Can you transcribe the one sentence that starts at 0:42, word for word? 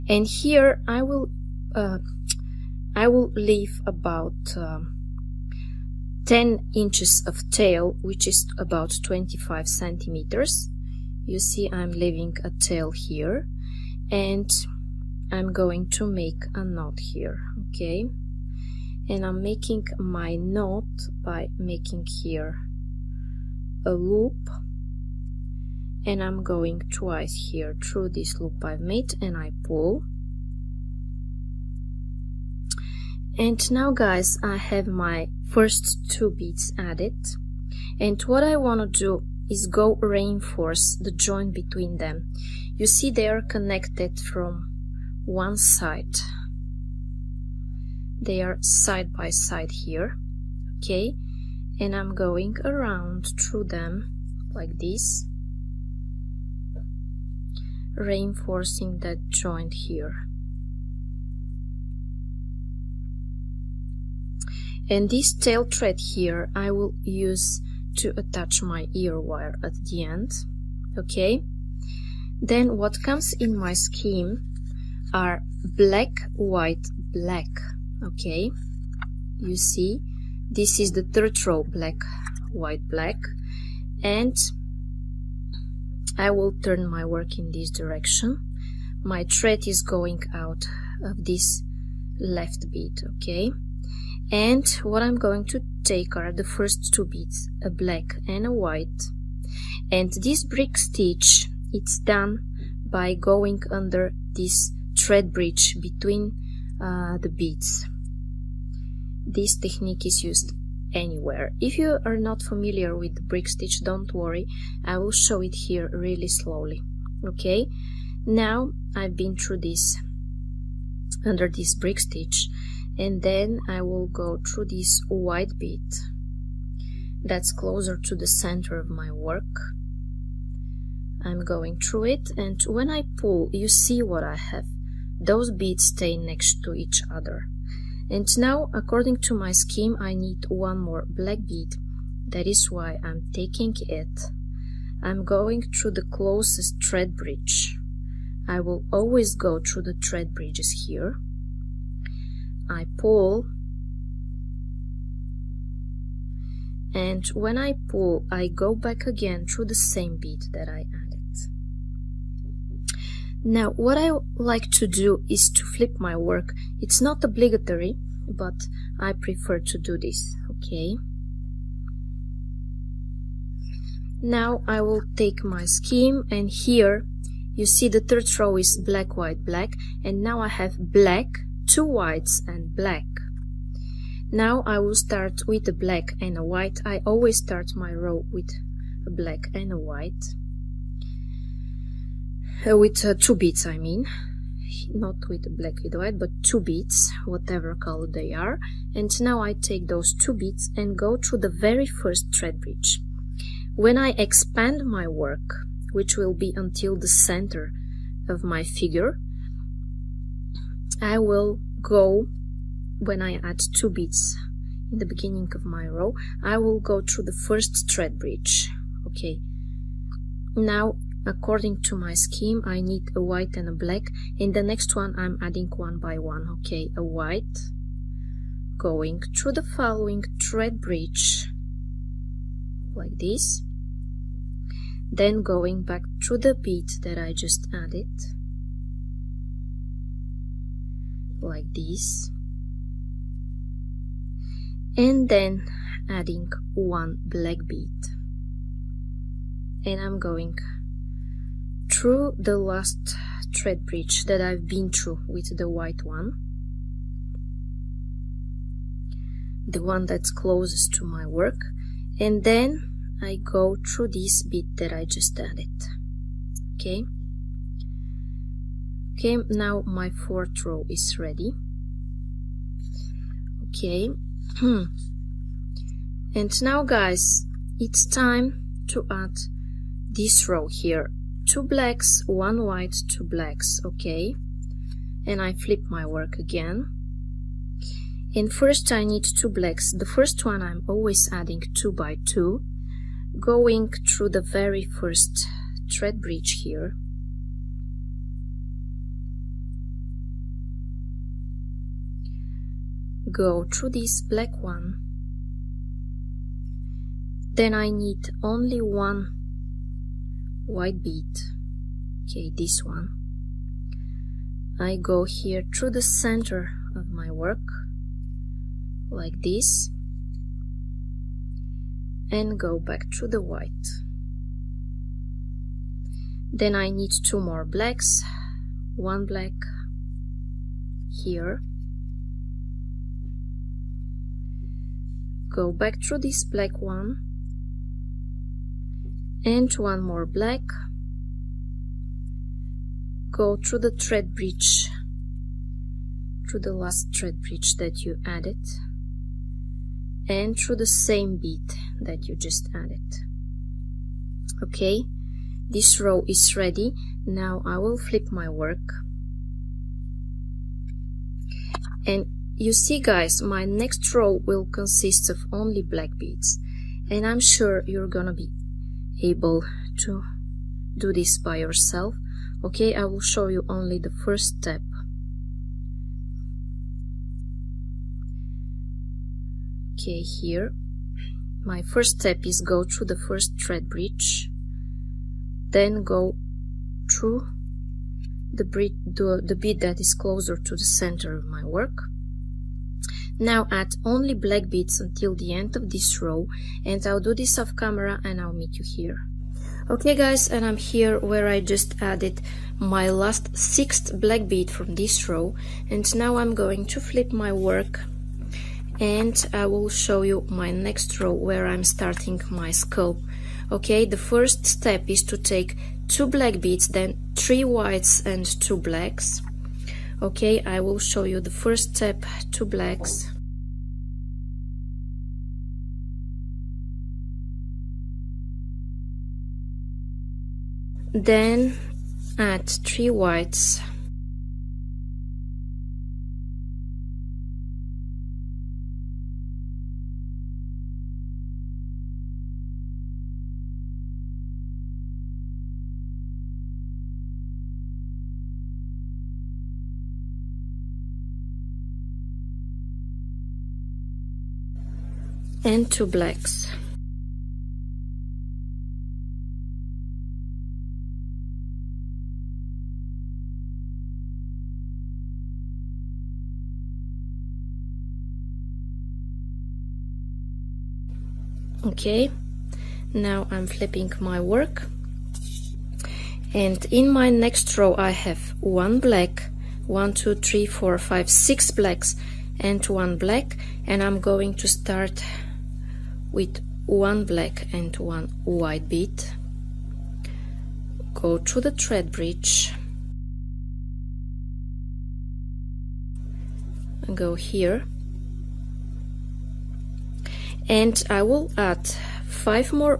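You see they are connected from one side.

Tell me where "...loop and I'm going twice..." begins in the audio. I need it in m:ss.
0:23.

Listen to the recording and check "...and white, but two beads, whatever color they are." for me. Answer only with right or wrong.
right.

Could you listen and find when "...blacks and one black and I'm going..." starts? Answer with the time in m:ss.
8:01.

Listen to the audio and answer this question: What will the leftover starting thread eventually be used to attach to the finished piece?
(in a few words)
ear wire.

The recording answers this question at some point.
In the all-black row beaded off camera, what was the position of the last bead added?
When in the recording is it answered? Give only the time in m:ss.
6:43.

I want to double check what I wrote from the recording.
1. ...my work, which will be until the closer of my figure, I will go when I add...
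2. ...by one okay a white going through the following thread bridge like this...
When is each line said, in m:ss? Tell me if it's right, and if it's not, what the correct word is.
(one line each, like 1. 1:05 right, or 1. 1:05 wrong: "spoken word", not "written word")
1. 3:24 wrong: "center", not "closer"
2. 3:45 right.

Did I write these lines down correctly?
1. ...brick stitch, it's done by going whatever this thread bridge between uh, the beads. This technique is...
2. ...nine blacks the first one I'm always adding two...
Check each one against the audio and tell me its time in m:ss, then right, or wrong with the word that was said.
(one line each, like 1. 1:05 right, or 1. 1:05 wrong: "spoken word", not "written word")
1. 1:40 wrong: "under", not "whatever"
2. 4:49 wrong: "two", not "nine".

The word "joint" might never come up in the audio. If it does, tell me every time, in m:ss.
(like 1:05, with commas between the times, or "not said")
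0:41, 0:59.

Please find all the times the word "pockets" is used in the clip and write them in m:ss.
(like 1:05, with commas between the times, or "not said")
not said.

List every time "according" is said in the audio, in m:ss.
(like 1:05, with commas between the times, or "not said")
2:18, 3:41.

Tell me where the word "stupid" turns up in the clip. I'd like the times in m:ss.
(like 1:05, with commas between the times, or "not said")
not said.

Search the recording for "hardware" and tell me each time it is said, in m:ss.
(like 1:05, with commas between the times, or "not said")
not said.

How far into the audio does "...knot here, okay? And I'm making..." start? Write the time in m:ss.
0:16.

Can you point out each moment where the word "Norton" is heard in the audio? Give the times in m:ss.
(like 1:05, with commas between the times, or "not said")
not said.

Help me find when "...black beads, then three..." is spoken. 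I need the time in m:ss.
6:56.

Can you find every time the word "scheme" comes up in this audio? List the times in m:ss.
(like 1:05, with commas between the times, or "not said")
1:13, 2:19, 2:55, 3:42.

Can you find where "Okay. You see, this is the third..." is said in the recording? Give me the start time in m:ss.
1:18.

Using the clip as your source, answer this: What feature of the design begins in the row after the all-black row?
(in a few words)
skull.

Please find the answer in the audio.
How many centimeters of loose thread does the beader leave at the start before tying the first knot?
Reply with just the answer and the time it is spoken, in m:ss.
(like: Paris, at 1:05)
25, at 0:09.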